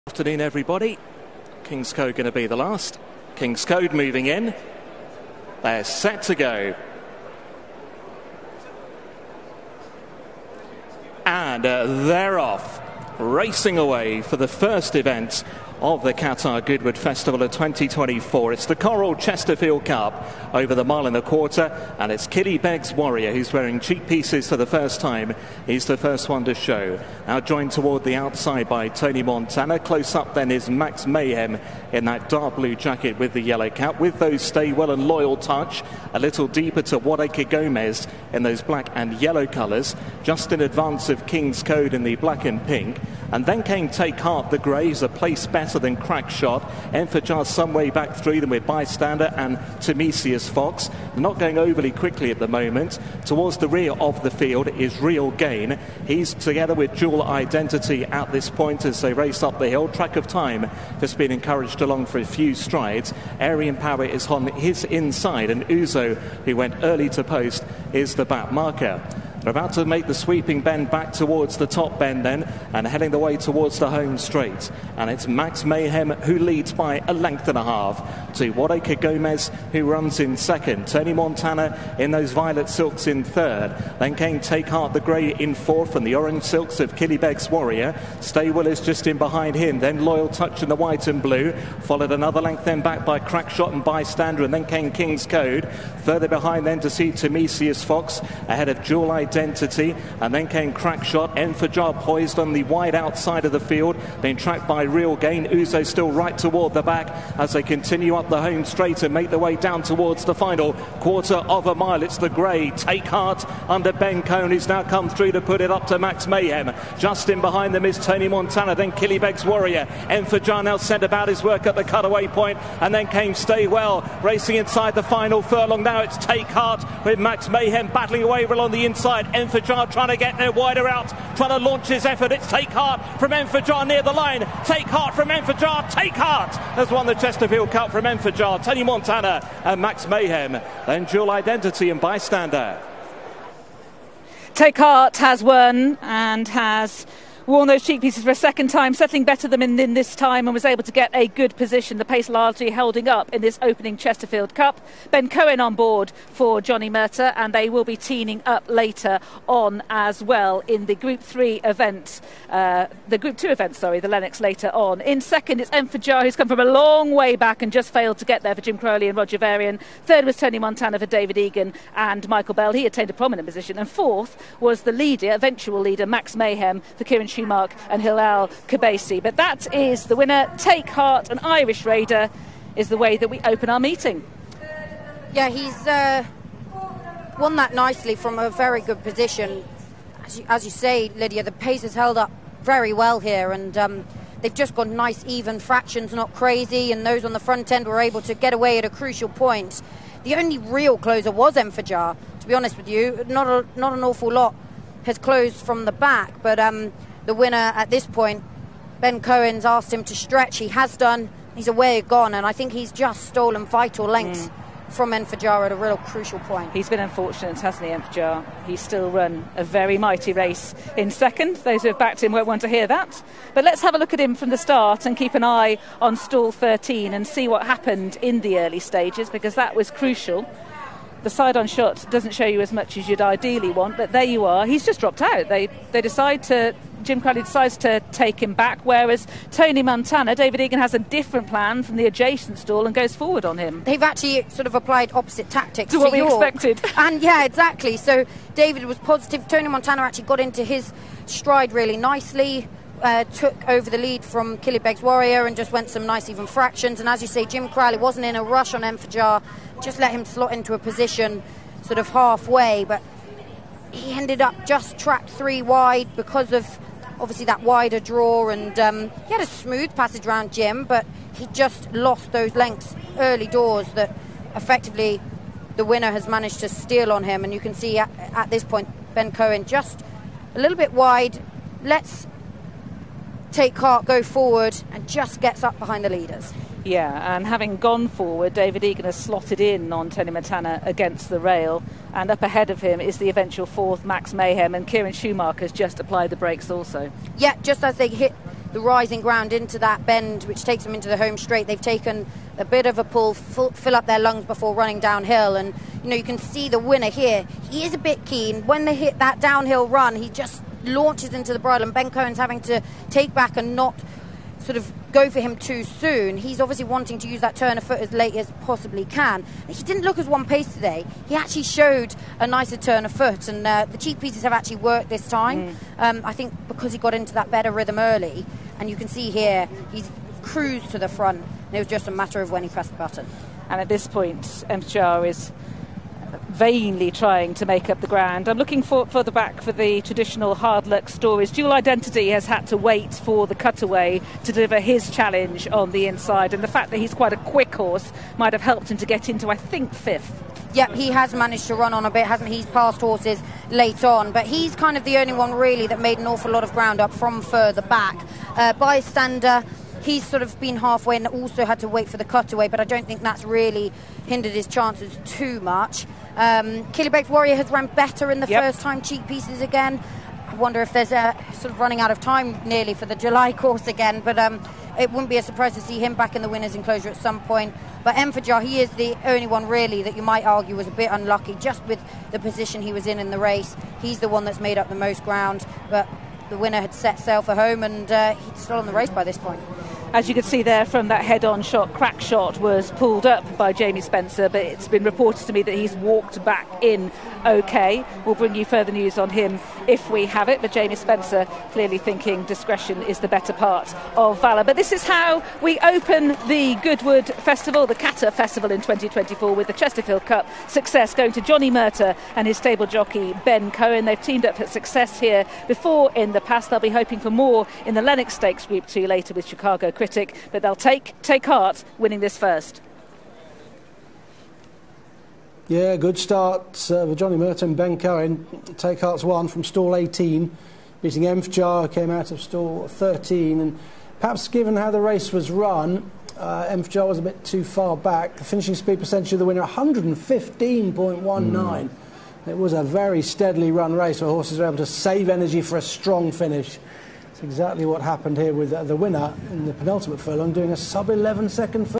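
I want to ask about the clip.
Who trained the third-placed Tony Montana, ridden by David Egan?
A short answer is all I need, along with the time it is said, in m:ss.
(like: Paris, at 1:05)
Michael Bell, at 2:52.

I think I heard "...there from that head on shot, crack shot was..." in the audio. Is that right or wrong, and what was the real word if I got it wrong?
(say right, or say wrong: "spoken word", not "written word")
right.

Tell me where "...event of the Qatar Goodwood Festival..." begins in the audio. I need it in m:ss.
0:14.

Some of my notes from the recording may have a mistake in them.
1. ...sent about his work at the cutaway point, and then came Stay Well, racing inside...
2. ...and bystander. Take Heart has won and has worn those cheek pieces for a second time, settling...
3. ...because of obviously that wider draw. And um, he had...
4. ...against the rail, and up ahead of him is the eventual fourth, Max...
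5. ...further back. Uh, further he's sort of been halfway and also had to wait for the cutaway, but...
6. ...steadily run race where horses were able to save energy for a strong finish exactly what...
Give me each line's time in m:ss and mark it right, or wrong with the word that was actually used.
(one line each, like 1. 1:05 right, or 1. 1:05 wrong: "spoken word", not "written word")
1. 2:00 right
2. 2:21 right
3. 4:26 right
4. 4:50 right
5. 5:57 wrong: "bystander", not "further"
6. 7:23 right.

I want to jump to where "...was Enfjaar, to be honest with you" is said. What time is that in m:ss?
3:21.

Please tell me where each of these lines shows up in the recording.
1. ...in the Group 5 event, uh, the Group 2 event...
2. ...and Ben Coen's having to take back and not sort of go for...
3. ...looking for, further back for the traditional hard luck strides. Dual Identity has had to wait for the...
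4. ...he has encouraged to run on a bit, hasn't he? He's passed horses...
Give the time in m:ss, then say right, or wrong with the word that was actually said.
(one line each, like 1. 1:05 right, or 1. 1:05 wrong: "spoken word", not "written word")
1. 2:40 wrong: "3", not "5"
2. 5:11 right
3. 5:38 wrong: "stories", not "strides"
4. 5:50 wrong: "managed", not "encouraged".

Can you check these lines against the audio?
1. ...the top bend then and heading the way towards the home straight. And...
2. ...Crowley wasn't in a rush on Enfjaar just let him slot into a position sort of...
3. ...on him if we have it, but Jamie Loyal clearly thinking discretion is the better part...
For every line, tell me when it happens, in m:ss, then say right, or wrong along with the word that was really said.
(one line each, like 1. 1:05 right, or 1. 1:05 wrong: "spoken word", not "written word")
1. 1:11 right
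2. 4:17 right
3. 6:39 wrong: "Spencer", not "Loyal".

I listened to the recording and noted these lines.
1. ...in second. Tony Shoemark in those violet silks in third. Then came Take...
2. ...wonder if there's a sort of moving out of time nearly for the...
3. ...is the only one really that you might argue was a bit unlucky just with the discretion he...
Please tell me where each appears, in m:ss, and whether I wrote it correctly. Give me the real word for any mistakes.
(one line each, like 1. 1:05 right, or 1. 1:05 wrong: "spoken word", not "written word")
1. 1:20 wrong: "Montana", not "Shoemark"
2. 6:10 wrong: "running", not "moving"
3. 6:18 wrong: "position", not "discretion".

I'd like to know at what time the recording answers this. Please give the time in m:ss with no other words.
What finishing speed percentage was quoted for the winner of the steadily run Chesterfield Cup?
7:19.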